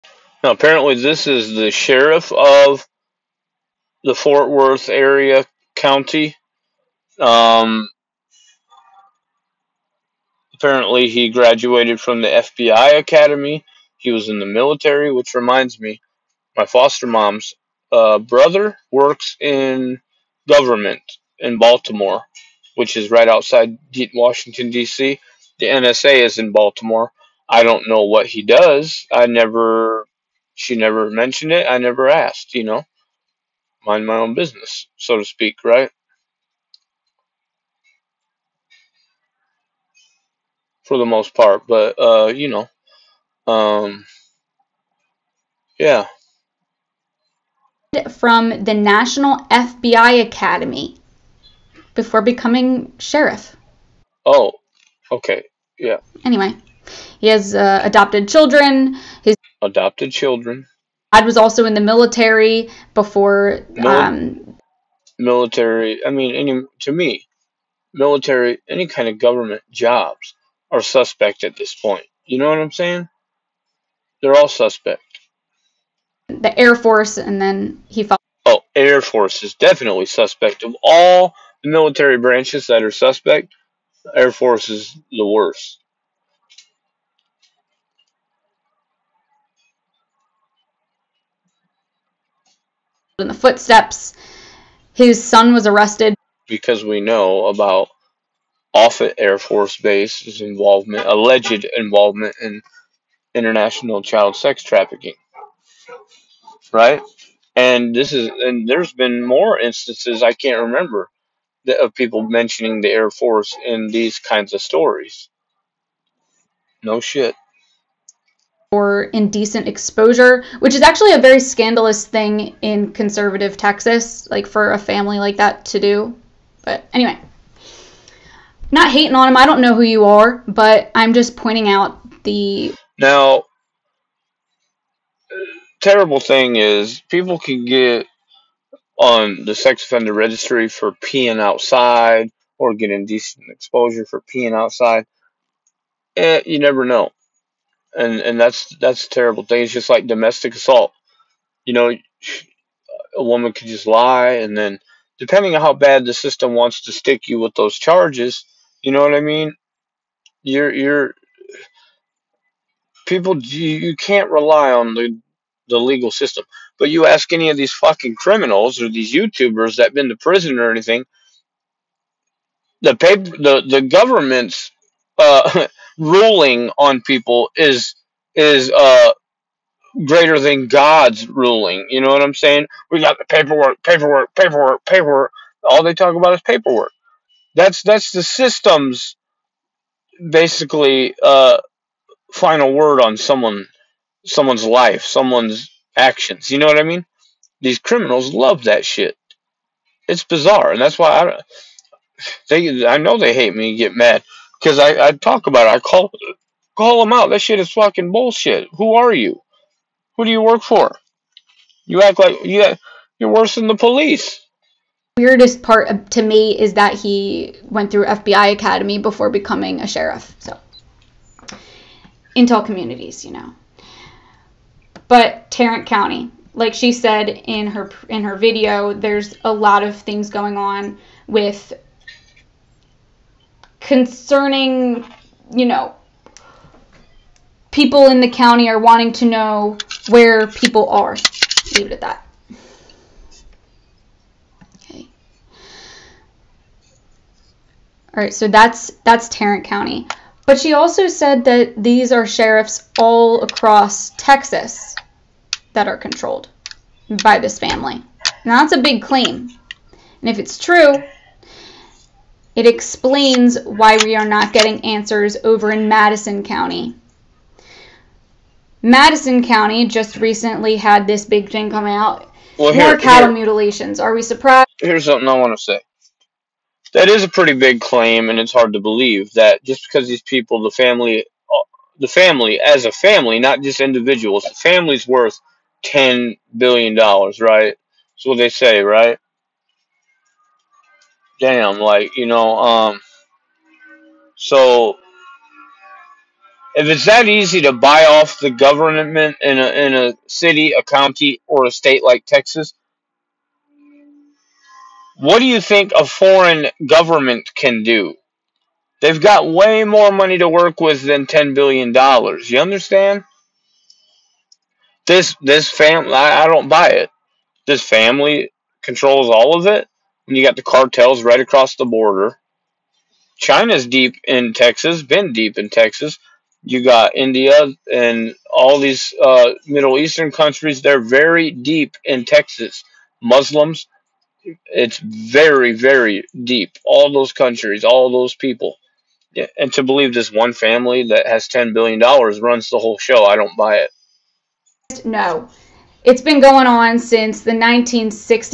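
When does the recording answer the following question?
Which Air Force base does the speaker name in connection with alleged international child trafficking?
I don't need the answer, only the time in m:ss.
1:38.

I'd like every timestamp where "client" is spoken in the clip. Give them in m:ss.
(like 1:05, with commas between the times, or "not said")
not said.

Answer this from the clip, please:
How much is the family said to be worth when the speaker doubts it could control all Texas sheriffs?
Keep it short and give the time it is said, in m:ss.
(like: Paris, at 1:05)
$10 billion, at 4:45.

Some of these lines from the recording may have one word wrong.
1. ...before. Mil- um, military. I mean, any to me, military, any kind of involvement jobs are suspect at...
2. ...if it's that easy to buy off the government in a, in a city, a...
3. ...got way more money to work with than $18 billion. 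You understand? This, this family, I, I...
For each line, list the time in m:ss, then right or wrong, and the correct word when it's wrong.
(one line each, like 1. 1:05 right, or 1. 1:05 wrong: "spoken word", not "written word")
1. 1:02 wrong: "government", not "involvement"
2. 4:56 right
3. 5:09 wrong: "10", not "18".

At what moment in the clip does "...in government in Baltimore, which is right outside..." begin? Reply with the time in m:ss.
0:19.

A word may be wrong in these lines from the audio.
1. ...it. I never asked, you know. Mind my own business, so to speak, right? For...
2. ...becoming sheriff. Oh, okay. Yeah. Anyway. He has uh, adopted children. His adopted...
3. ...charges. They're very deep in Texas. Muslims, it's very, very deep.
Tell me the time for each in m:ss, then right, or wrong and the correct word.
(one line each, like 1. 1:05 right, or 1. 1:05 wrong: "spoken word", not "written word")
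1. 0:31 right
2. 0:52 right
3. 5:30 wrong: "countries", not "charges".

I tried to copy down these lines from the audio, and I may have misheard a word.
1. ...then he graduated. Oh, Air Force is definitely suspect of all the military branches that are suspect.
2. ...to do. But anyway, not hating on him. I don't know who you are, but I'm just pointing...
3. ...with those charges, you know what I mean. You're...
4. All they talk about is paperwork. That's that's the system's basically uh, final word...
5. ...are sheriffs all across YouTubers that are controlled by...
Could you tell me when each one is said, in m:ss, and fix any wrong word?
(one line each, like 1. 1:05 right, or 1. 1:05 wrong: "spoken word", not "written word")
1. 1:17 wrong: "followed", not "graduated"
2. 2:05 right
3. 2:37 right
4. 3:05 right
5. 4:12 wrong: "Texas", not "YouTubers".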